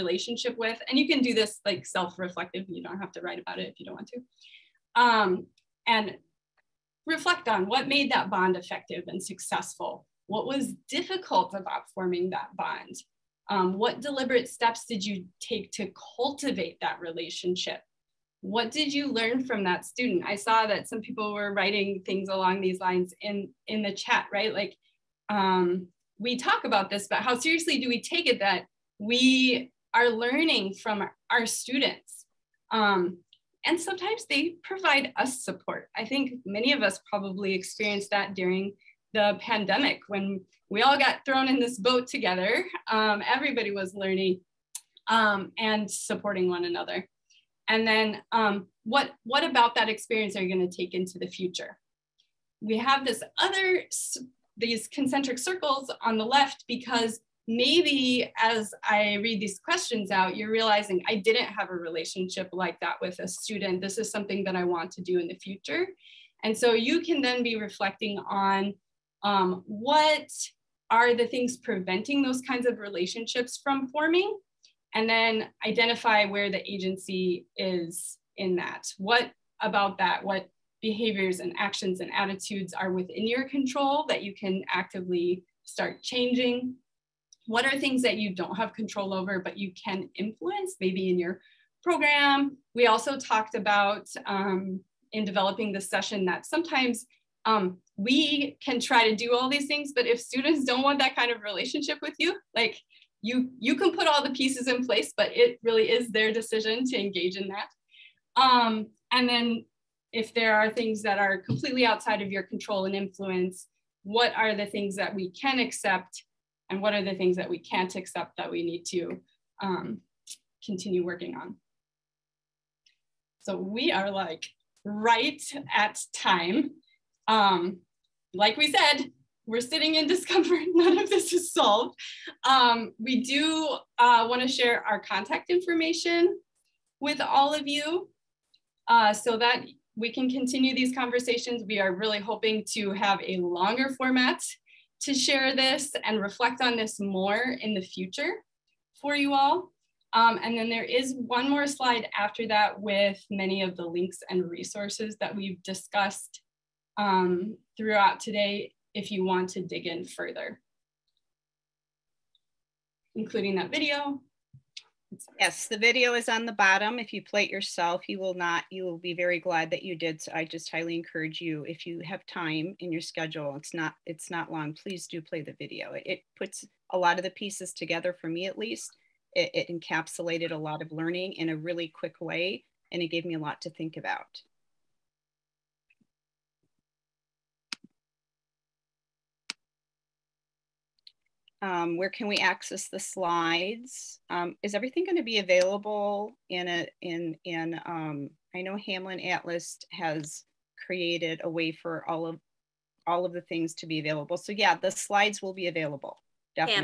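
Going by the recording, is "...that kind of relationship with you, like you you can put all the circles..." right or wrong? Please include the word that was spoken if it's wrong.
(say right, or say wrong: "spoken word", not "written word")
wrong: "pieces", not "circles".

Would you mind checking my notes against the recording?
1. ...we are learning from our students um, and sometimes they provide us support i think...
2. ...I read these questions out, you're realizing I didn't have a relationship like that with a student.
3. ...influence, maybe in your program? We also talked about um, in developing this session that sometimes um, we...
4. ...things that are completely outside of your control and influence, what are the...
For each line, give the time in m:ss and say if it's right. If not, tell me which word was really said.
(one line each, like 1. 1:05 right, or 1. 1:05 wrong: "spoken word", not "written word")
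1. 0:28 right
2. 0:58 right
3. 1:30 right
4. 1:50 right.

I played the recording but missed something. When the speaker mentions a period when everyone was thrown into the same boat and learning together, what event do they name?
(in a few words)
the pandemic.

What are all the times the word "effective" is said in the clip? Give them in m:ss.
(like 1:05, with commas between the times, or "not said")
0:08.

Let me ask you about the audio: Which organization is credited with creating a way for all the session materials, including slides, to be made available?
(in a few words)
Hamline Atlas.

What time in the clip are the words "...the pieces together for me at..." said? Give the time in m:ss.
2:57.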